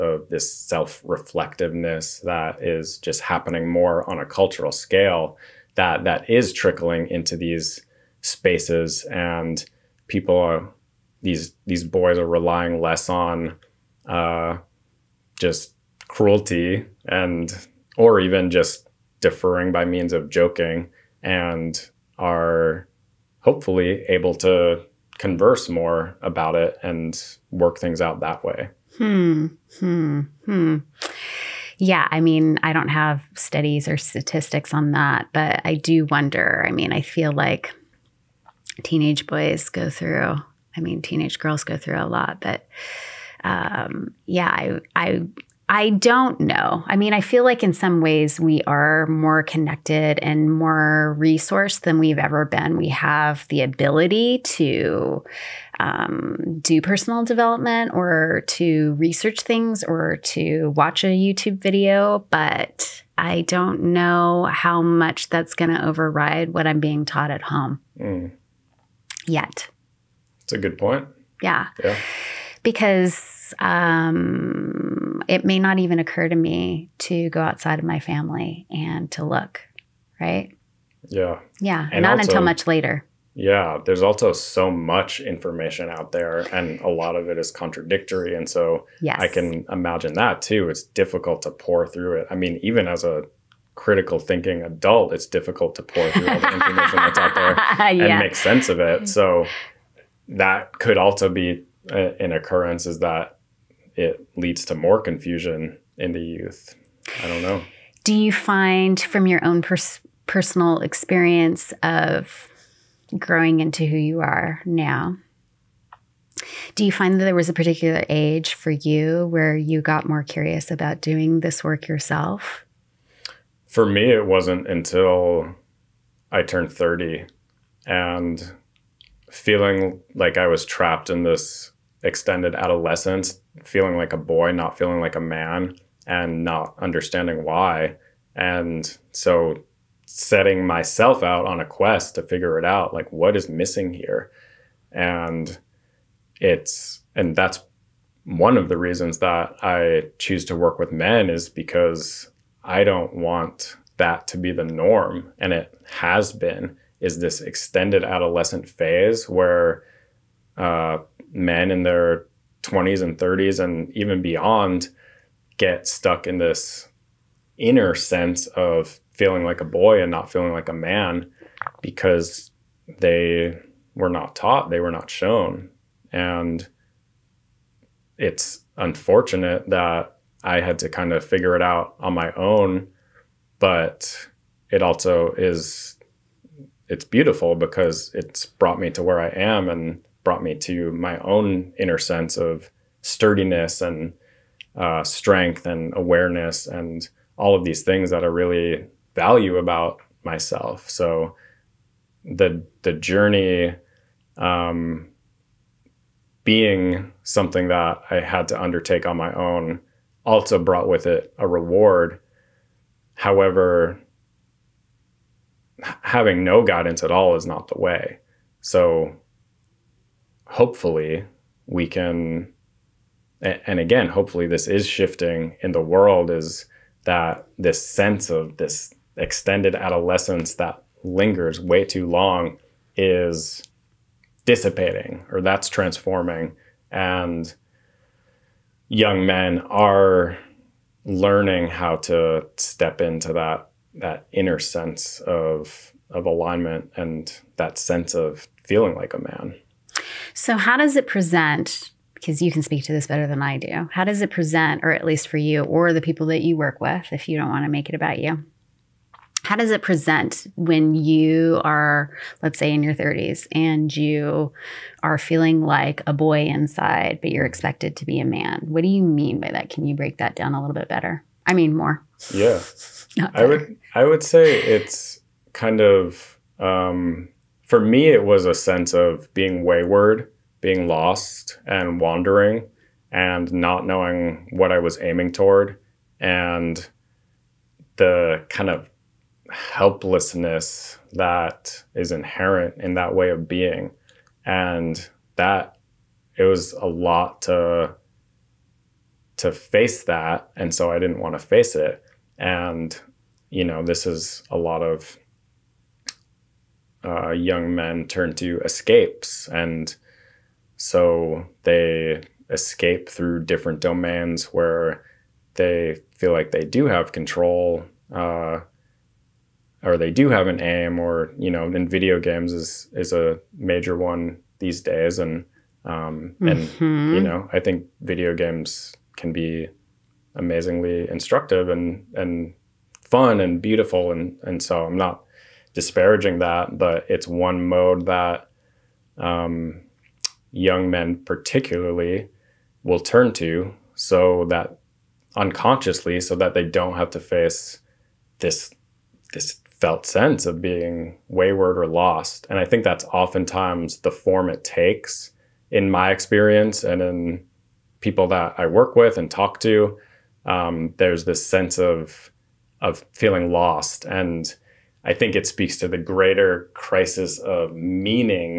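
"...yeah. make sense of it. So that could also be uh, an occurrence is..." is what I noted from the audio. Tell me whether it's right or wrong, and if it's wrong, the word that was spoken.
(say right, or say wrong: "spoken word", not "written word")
right.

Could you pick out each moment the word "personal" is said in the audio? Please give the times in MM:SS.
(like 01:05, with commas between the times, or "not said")
00:56, 01:50.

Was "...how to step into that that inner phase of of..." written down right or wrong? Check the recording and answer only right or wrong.
wrong.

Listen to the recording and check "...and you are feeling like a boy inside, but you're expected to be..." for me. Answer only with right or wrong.
right.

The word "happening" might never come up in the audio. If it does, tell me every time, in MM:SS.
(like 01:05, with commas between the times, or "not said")
00:03.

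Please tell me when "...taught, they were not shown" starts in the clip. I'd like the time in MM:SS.
02:54.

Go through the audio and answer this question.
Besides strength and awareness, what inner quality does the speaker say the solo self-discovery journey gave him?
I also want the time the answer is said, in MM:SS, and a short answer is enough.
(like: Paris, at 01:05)
sturdiness, at 03:13.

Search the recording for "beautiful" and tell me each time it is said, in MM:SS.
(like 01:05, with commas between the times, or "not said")
03:07, 05:33.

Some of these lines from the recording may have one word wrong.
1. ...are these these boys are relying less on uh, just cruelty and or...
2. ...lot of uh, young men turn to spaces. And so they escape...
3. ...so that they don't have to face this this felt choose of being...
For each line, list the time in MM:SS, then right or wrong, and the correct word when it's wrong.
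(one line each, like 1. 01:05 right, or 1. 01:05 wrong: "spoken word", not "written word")
1. 00:10 right
2. 05:04 wrong: "escapes", not "spaces"
3. 05:46 wrong: "sense", not "choose".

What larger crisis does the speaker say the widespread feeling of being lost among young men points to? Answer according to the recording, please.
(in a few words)
crisis of meaning.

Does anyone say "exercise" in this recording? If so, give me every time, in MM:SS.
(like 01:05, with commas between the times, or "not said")
not said.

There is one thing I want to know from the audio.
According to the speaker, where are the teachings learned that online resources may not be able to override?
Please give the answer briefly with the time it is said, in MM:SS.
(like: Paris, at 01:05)
at home, at 01:07.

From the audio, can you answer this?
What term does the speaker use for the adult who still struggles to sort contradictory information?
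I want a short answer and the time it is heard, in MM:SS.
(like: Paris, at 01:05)
critical thinking adult, at 01:33.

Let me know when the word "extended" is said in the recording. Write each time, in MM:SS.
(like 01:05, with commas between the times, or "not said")
02:12, 02:37, 03:49.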